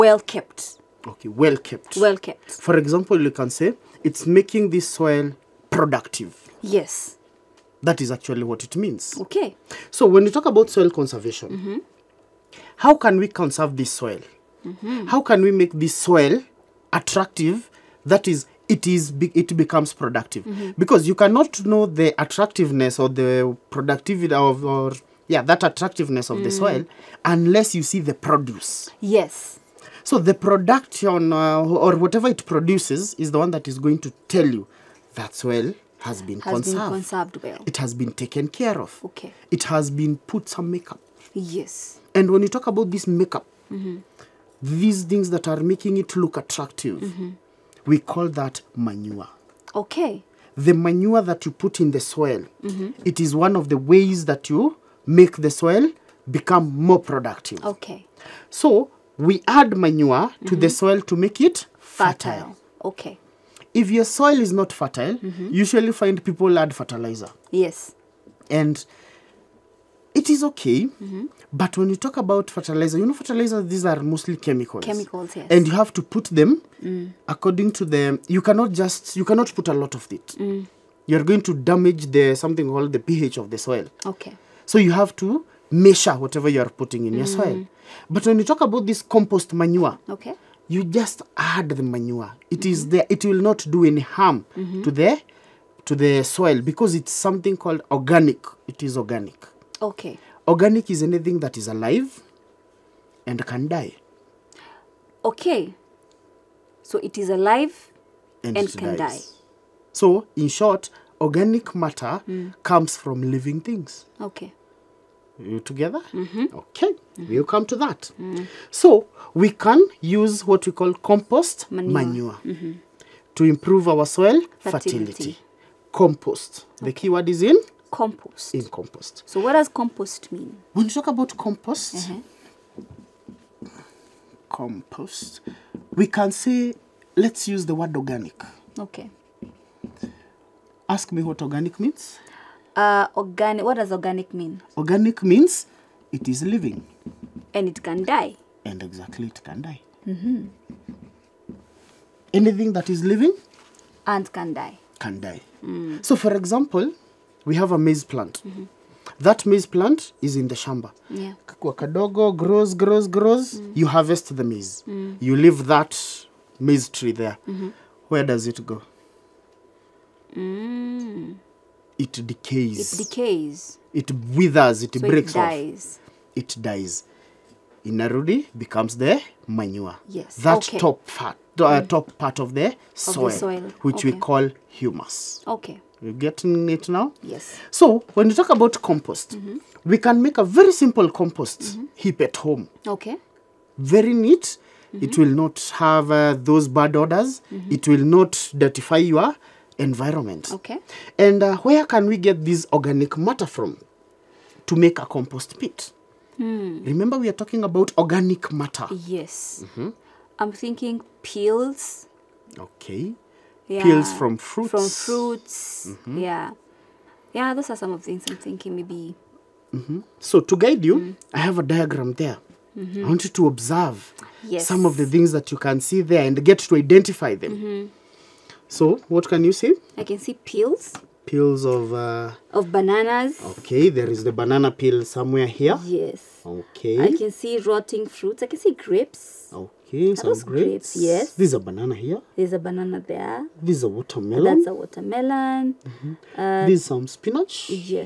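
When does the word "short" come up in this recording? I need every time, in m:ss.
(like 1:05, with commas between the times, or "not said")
1:50.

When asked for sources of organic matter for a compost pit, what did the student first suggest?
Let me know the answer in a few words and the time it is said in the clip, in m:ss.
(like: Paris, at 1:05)
peels from fruits, at 3:33.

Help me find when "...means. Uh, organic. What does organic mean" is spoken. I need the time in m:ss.
2:21.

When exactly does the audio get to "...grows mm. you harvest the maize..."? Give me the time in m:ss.
2:43.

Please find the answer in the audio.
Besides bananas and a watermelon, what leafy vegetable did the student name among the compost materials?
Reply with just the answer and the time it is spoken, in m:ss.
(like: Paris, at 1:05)
spinach, at 4:07.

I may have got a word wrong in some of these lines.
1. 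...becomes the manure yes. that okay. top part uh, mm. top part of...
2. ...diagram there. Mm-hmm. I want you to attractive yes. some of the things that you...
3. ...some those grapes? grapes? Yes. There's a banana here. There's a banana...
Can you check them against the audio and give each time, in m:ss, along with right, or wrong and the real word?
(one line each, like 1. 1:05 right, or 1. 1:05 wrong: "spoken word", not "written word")
1. 2:58 right
2. 3:41 wrong: "observe", not "attractive"
3. 4:00 right.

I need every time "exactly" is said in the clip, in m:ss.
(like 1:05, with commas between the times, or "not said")
2:28.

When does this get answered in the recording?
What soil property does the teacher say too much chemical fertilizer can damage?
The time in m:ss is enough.
1:22.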